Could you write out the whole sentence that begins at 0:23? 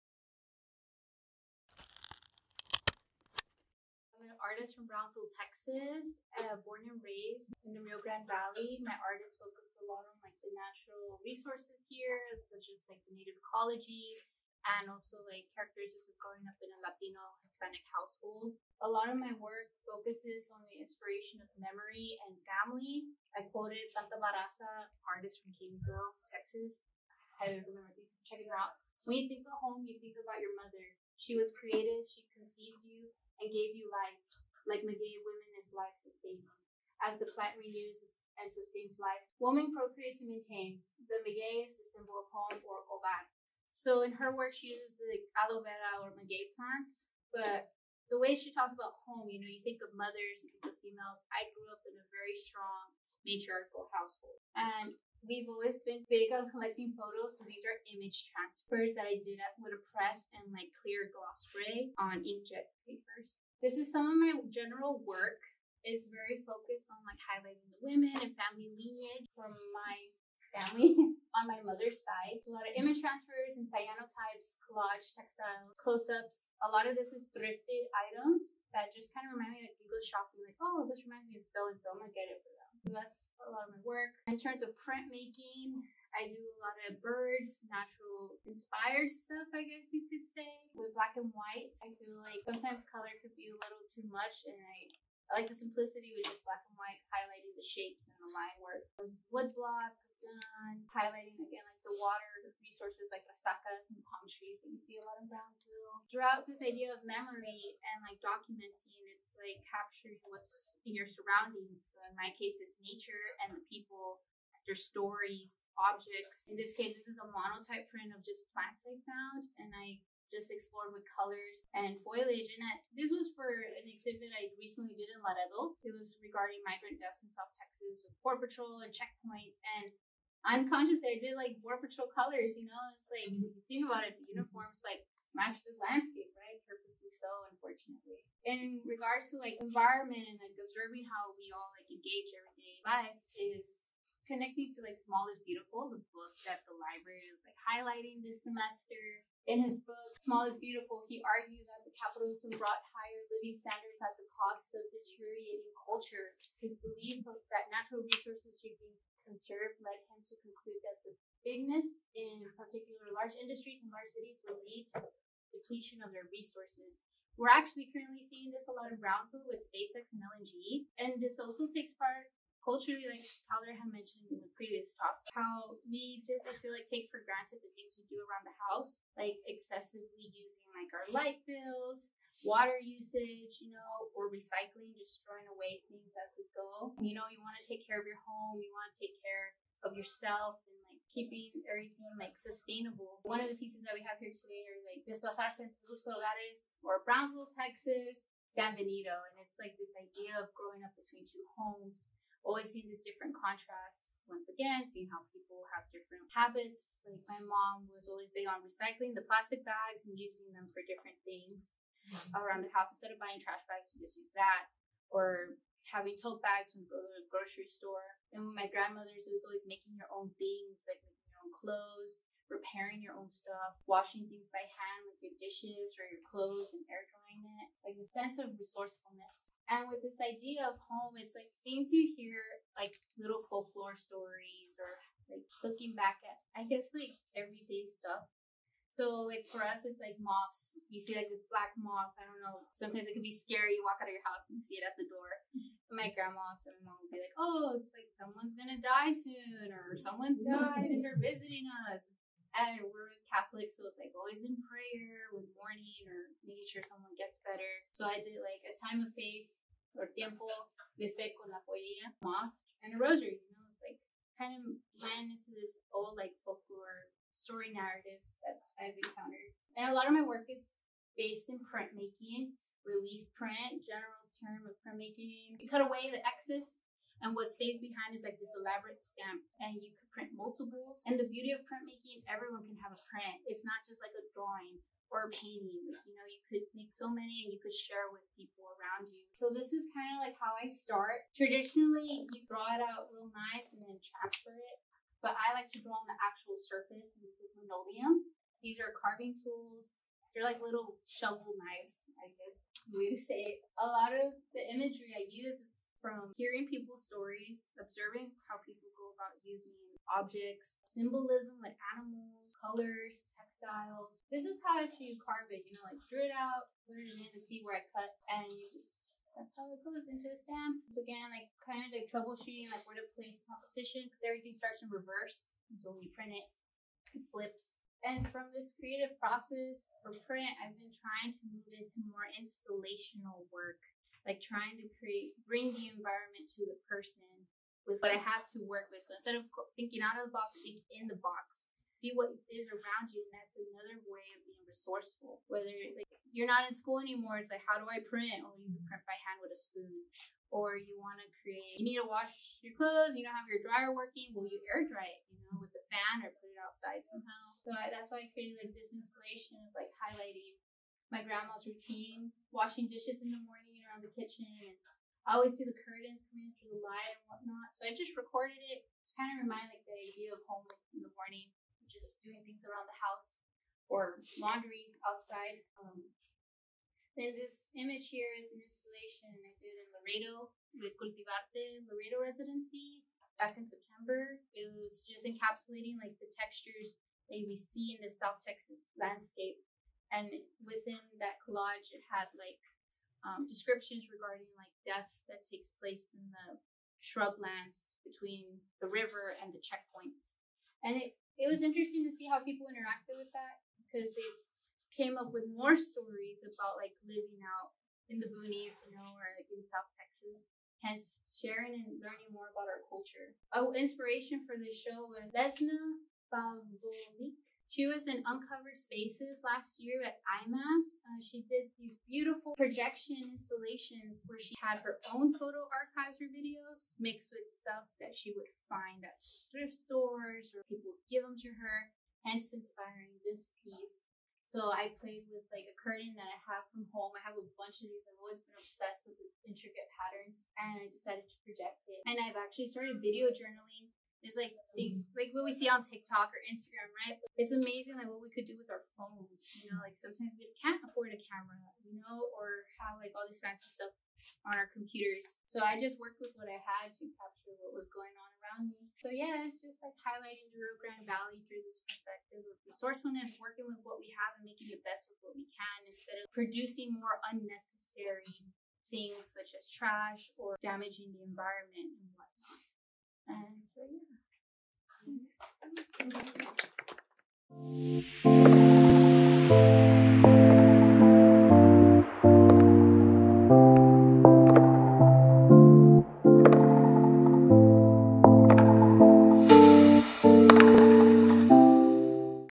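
I quoted Santa Barraza, artist from Kingsville, Texas.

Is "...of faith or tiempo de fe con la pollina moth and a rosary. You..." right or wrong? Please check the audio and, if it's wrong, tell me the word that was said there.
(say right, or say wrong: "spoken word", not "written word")
right.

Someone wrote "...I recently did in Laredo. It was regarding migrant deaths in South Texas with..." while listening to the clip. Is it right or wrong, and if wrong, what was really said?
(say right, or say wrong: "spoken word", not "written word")
right.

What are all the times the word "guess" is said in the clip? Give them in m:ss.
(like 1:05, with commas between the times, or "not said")
1:29, 3:56, 5:02.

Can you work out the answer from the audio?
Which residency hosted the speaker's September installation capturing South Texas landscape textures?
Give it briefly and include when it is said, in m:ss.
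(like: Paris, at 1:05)
Cultivarte Laredo Residency, at 6:20.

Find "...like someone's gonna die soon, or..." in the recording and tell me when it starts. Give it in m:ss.
4:07.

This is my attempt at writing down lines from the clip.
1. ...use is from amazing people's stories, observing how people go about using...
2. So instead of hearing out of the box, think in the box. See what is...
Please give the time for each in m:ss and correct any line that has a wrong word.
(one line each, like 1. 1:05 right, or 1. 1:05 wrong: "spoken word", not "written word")
1. 5:05 wrong: "hearing", not "amazing"
2. 5:39 wrong: "thinking", not "hearing".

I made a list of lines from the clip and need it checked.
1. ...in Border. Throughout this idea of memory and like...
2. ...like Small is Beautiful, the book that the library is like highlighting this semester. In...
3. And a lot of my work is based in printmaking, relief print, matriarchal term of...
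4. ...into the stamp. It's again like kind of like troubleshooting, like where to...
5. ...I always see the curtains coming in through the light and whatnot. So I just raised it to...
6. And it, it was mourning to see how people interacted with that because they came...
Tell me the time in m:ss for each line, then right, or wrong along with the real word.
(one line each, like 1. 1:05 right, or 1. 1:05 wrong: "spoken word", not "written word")
1. 1:45 wrong: "Brownsville", not "Border"
2. 2:24 right
3. 4:29 wrong: "general", not "matriarchal"
4. 5:20 right
5. 6:05 wrong: "recorded", not "raised"
6. 6:40 wrong: "interesting", not "mourning".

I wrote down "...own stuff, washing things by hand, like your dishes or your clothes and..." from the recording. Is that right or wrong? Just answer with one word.
right.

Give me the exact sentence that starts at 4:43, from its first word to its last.
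It's not just like a drawing or a painting.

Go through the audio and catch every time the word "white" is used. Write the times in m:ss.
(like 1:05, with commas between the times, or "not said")
1:31, 1:36.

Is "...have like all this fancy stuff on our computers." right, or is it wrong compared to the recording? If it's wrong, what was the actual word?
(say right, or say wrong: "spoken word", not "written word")
right.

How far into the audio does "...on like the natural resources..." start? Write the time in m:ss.
0:10.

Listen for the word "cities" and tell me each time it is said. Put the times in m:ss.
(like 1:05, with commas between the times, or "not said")
2:44.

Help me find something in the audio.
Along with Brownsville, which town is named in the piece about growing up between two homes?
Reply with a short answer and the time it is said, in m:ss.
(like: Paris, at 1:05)
San Benito, at 3:18.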